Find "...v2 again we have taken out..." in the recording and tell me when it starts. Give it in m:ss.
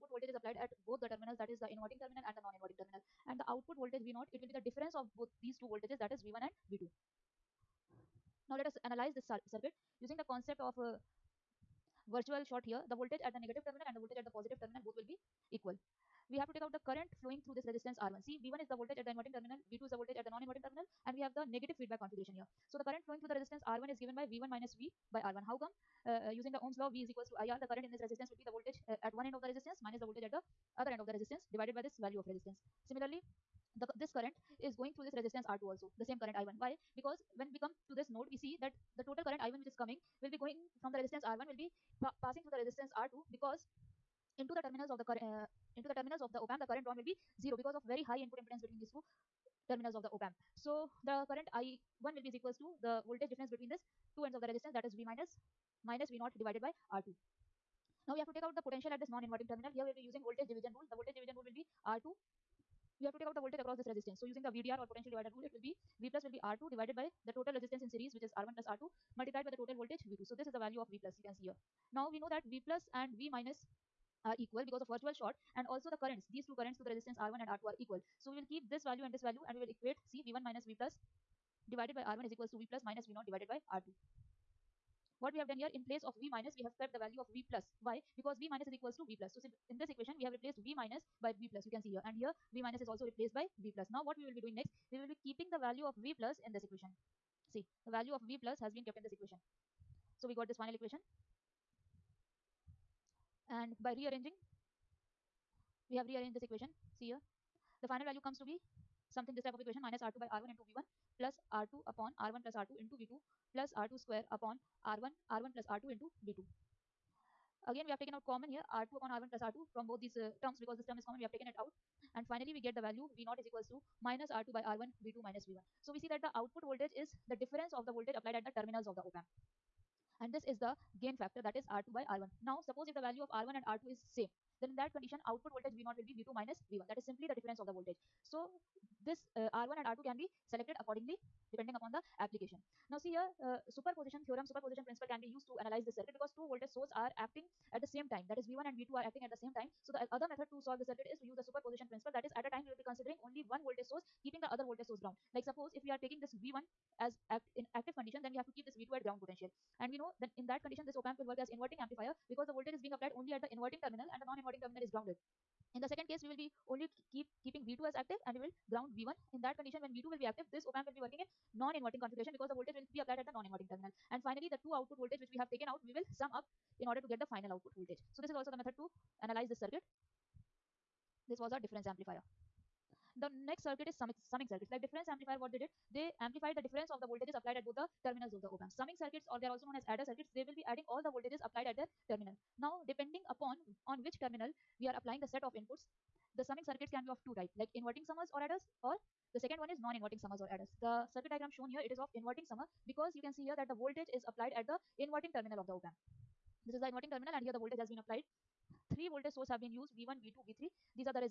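1:56.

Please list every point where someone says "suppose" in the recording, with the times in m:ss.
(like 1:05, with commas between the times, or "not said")
2:12, 2:35.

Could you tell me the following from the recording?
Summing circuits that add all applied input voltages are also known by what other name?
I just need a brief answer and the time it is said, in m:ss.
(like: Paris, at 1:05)
Adder circuits, at 3:09.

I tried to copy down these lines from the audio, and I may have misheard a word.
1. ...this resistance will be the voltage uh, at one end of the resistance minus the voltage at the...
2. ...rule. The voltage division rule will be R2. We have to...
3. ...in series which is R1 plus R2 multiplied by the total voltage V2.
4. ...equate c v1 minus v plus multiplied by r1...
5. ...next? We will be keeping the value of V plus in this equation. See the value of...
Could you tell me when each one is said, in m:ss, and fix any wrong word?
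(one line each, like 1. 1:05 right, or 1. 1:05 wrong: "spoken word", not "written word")
1. 0:27 right
2. 1:00 right
3. 1:07 right
4. 1:19 wrong: "divided", not "multiplied"
5. 1:34 right.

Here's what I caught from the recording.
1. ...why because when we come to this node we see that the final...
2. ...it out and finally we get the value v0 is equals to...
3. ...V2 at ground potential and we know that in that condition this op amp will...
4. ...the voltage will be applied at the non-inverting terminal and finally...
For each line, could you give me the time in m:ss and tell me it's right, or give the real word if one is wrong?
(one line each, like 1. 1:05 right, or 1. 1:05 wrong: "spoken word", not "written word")
1. 0:36 wrong: "total", not "final"
2. 2:01 right
3. 2:38 right
4. 2:52 right.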